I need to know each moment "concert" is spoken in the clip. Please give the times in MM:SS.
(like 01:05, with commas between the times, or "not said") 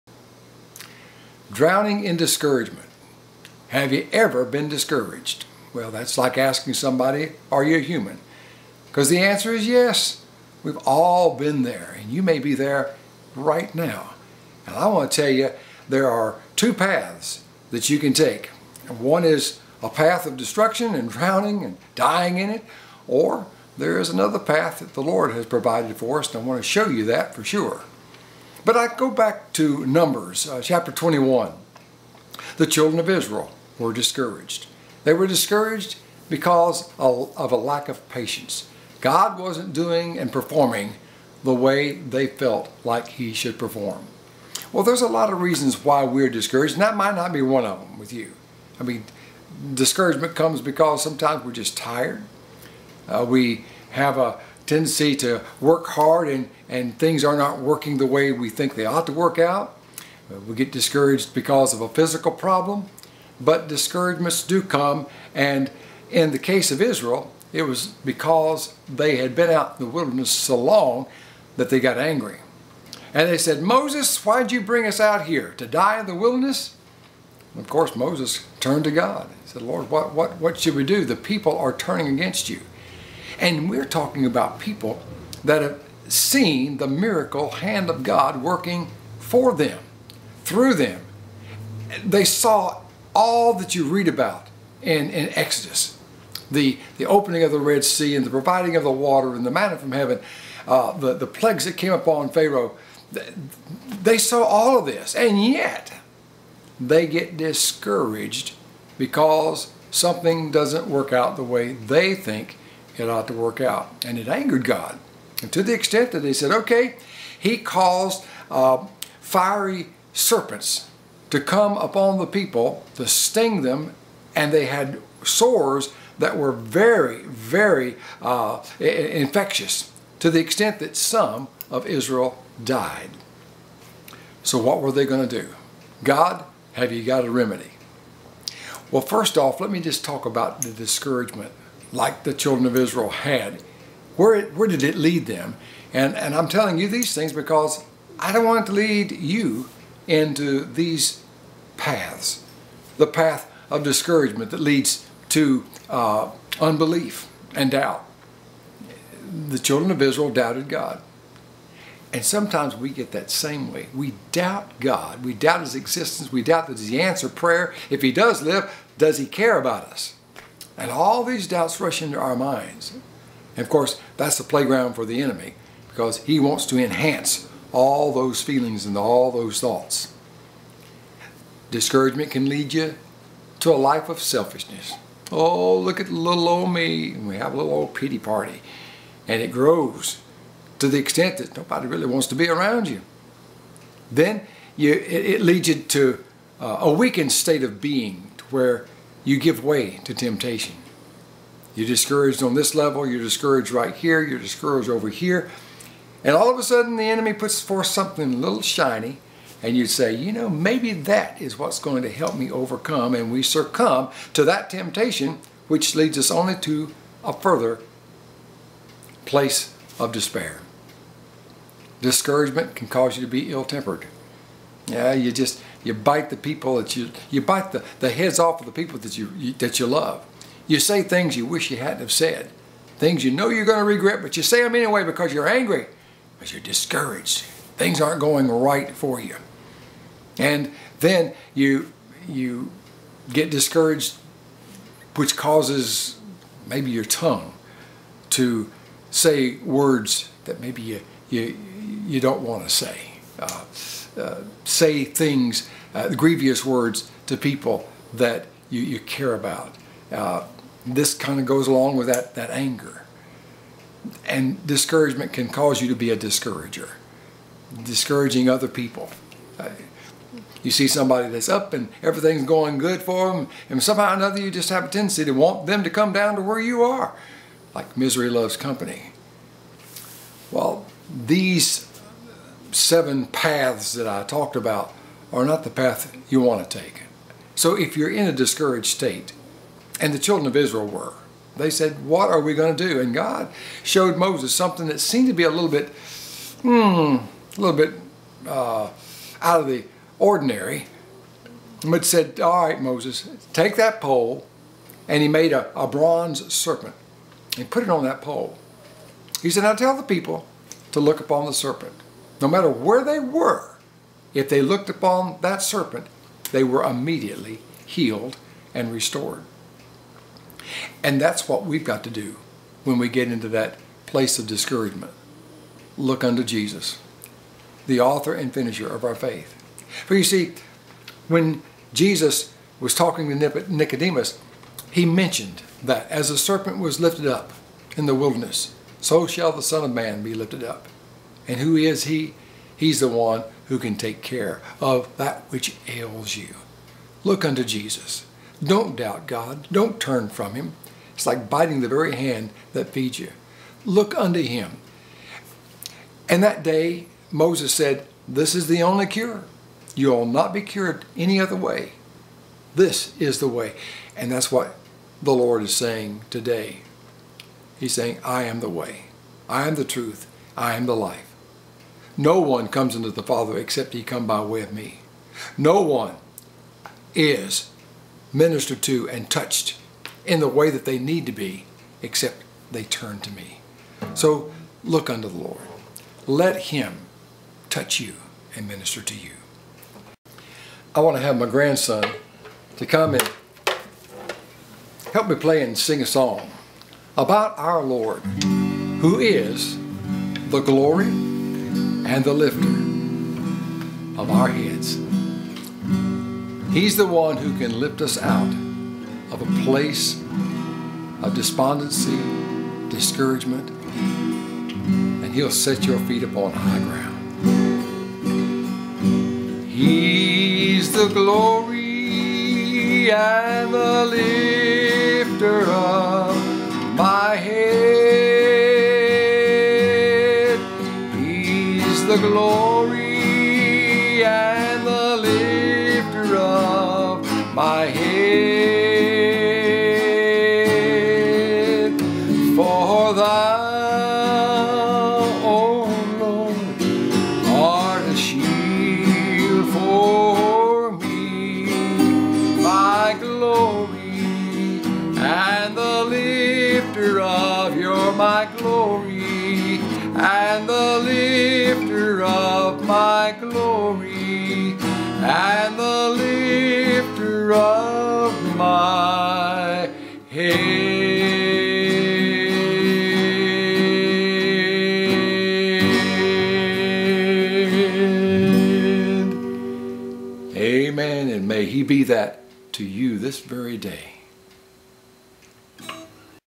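not said.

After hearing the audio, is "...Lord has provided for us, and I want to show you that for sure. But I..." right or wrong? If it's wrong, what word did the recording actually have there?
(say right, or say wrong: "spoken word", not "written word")
right.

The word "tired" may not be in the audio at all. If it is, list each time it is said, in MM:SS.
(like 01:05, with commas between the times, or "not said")
00:51.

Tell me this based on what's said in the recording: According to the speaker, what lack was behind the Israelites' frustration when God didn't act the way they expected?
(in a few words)
patience.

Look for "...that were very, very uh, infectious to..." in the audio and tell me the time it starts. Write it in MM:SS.
02:06.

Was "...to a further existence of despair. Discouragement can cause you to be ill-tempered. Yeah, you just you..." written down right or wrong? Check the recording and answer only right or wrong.
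wrong.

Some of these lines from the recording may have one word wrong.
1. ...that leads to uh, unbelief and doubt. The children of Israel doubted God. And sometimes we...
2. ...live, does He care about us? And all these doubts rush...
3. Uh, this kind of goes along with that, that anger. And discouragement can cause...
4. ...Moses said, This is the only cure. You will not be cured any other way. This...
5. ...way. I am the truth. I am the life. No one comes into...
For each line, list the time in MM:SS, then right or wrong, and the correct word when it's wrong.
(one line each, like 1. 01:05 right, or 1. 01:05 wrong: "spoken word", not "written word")
1. 02:34 right
2. 02:48 right
3. 04:20 right
4. 05:57 right
5. 06:08 right.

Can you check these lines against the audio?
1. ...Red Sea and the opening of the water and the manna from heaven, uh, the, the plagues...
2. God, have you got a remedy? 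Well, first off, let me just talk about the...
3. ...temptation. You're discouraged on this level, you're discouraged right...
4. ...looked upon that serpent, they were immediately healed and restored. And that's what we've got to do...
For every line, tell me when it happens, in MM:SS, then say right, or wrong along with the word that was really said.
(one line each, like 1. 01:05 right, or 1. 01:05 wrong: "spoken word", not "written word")
1. 01:37 wrong: "providing", not "opening"
2. 02:16 right
3. 03:20 right
4. 05:14 right.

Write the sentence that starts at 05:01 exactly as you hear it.
But said, All right, Moses, take that pole.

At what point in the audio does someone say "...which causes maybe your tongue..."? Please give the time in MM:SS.
04:05.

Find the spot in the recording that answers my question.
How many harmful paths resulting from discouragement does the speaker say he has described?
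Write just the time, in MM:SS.
04:42.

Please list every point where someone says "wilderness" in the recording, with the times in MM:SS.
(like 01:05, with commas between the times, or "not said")
01:09, 01:16, 05:38.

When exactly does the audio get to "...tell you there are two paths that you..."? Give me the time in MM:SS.
00:15.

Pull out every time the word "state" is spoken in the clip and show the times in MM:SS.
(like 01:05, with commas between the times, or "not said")
03:17, 04:48.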